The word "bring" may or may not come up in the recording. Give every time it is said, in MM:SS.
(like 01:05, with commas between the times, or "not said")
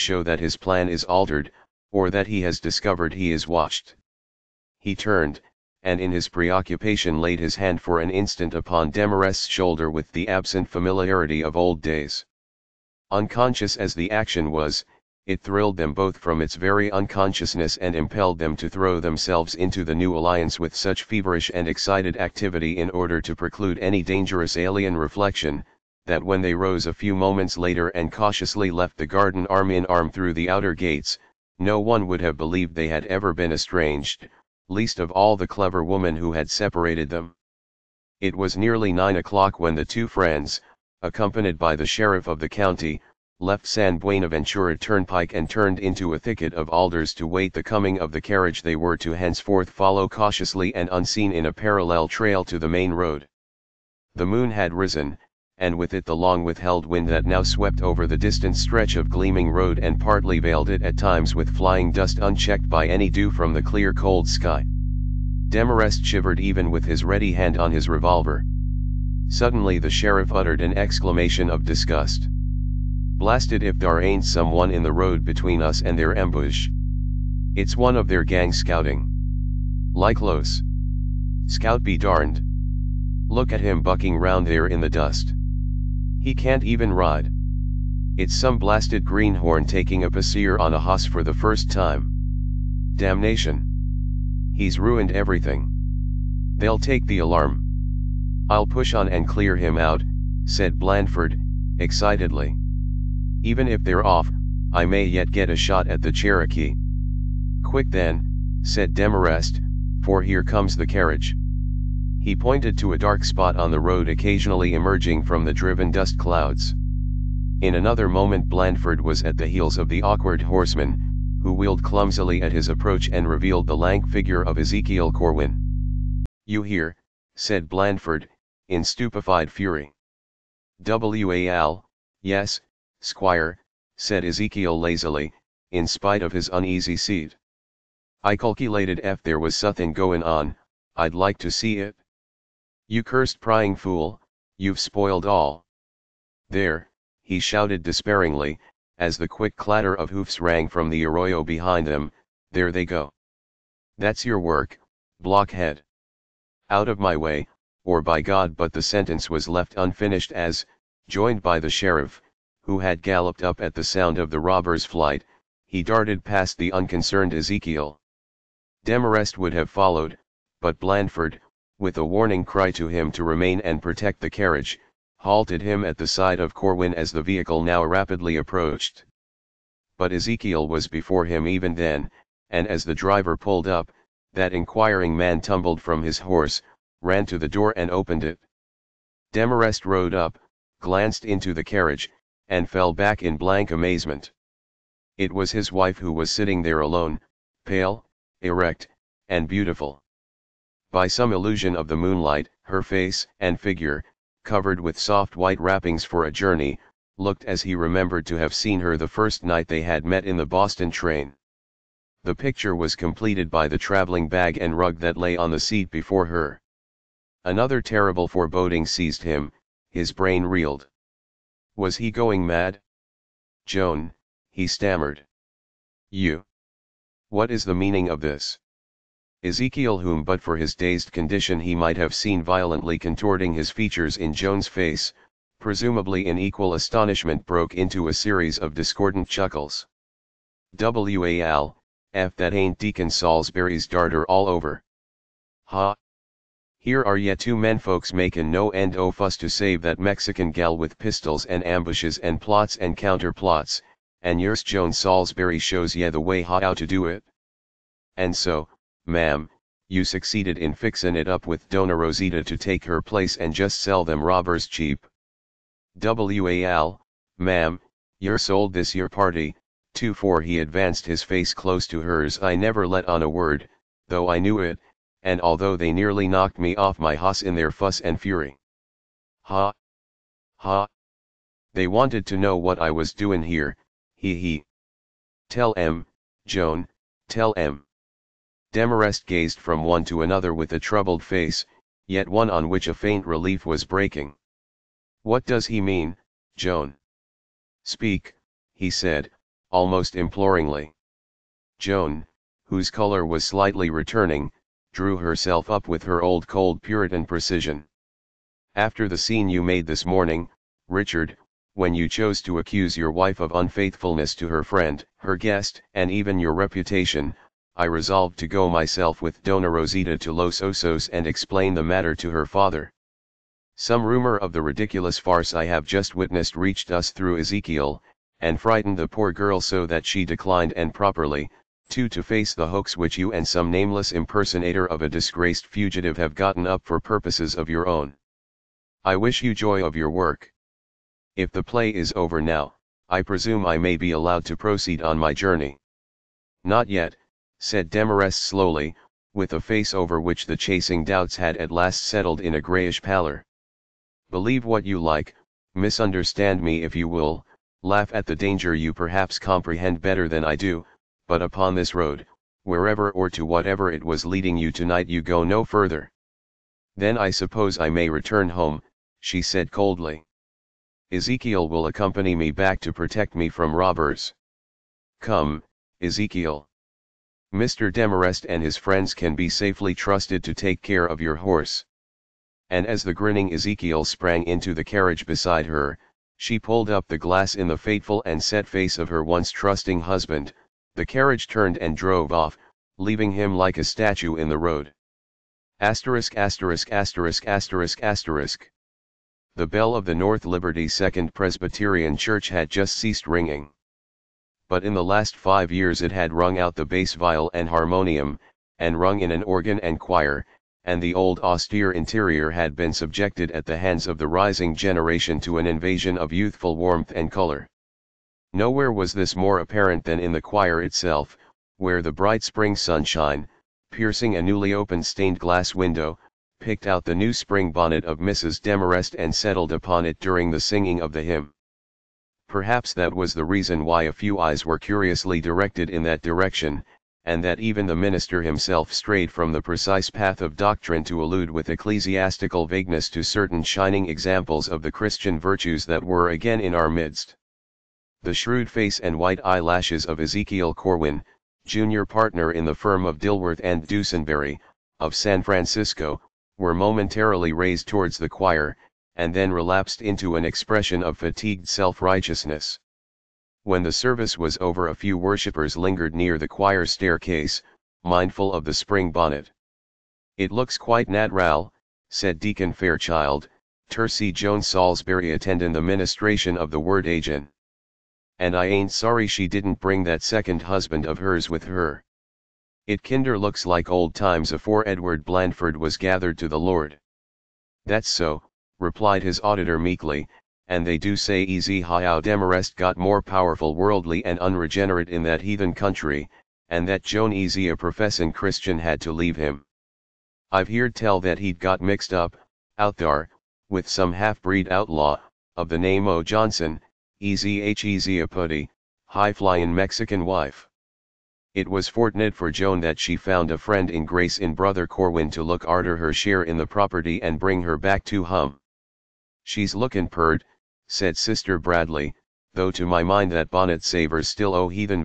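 07:59, 08:37.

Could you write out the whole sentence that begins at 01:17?
It's one of their gang scouting.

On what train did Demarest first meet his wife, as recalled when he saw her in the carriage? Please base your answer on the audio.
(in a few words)
The Boston train.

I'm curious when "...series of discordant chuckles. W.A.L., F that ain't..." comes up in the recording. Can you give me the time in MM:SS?
03:58.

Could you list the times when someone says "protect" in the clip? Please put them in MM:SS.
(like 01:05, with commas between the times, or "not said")
02:53, 06:12.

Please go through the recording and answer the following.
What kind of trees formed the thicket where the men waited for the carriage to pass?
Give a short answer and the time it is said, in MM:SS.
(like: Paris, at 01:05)
Alders, at 00:46.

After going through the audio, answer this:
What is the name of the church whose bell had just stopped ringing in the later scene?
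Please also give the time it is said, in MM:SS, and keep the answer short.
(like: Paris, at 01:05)
North Liberty Second Presbyterian Church, at 06:40.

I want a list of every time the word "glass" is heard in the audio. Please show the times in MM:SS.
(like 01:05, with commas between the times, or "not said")
06:27, 07:05.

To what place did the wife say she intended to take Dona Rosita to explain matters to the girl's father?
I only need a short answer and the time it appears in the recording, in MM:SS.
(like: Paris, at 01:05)
Los Osos, at 05:20.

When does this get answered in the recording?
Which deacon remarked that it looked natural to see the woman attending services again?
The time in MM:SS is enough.
07:52.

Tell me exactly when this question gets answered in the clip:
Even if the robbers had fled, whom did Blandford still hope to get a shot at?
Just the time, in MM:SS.
01:46.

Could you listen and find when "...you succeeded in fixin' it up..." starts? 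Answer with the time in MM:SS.
04:19.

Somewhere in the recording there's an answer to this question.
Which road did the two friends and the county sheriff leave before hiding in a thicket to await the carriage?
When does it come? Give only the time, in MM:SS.
00:43.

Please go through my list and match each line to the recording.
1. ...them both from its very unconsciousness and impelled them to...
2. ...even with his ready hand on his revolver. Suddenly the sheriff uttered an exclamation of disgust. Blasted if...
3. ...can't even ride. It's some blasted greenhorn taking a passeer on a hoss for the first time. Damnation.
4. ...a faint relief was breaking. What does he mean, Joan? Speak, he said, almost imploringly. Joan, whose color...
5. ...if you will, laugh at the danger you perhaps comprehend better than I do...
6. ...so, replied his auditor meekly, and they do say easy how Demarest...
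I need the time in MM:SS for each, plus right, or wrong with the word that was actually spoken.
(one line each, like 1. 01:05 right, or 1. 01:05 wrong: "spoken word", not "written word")
1. 00:15 right
2. 01:06 right
3. 01:26 right
4. 04:52 right
5. 05:56 right
6. 08:08 right.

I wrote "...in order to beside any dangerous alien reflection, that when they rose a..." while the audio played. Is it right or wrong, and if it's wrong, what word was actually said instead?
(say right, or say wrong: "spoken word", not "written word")
wrong: "preclude", not "beside".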